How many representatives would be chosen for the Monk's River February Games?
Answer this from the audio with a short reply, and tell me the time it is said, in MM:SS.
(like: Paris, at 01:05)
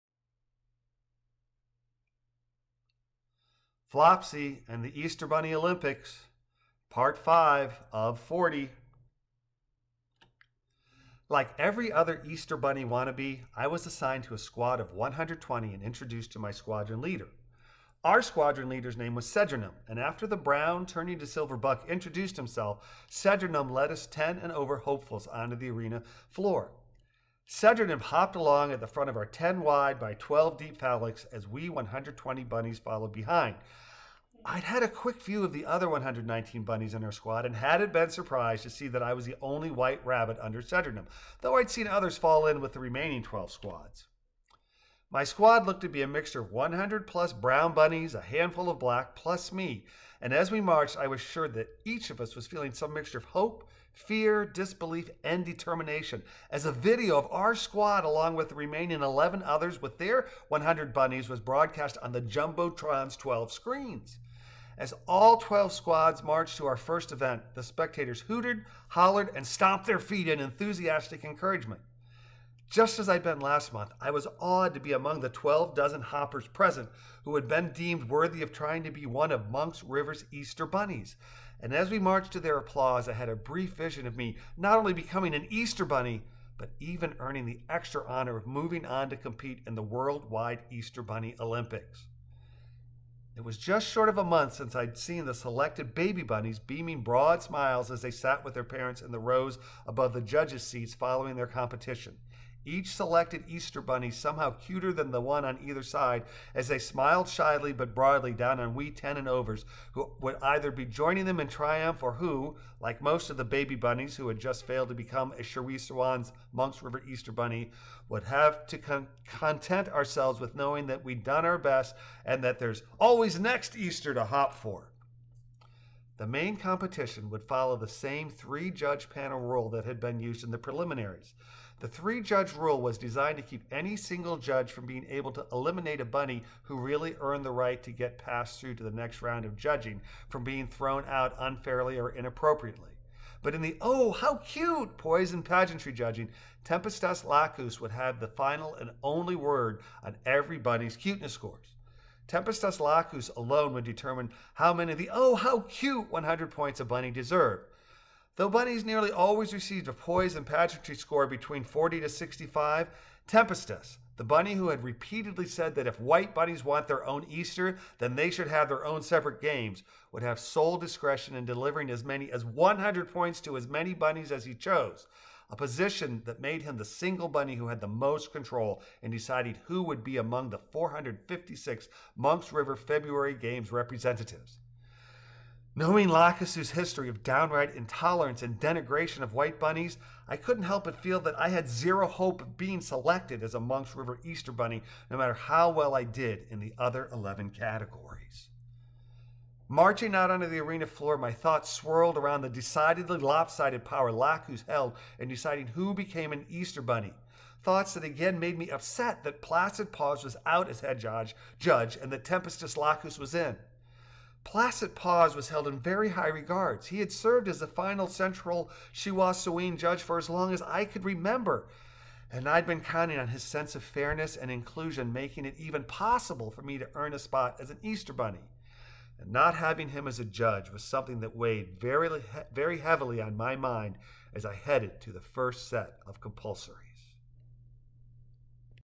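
456, at 03:00.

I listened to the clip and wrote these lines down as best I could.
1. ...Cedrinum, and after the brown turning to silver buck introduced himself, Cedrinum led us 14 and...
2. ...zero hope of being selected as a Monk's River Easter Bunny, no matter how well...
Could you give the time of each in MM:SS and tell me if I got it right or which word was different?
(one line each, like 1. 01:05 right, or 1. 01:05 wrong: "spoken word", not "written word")
1. 00:19 wrong: "10", not "14"
2. 03:11 right.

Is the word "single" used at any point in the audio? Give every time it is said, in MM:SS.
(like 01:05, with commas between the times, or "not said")
02:13, 02:56.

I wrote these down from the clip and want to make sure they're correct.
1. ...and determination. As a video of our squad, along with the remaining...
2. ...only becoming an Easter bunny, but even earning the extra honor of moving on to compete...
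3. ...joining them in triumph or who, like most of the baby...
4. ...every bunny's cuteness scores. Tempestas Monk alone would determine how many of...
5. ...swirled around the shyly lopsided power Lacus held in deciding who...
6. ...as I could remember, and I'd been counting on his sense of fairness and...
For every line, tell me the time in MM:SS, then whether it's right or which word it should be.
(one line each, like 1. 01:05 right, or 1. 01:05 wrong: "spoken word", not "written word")
1. 00:55 right
2. 01:24 right
3. 01:50 right
4. 02:30 wrong: "Lacus", not "Monk"
5. 03:21 wrong: "decidedly", not "shyly"
6. 03:40 right.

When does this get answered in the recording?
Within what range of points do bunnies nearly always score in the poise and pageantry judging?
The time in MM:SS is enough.
02:41.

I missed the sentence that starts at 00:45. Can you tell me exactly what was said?
My squad looked to be a mixture of 100 plus brown bunnies, a handful of black, plus me.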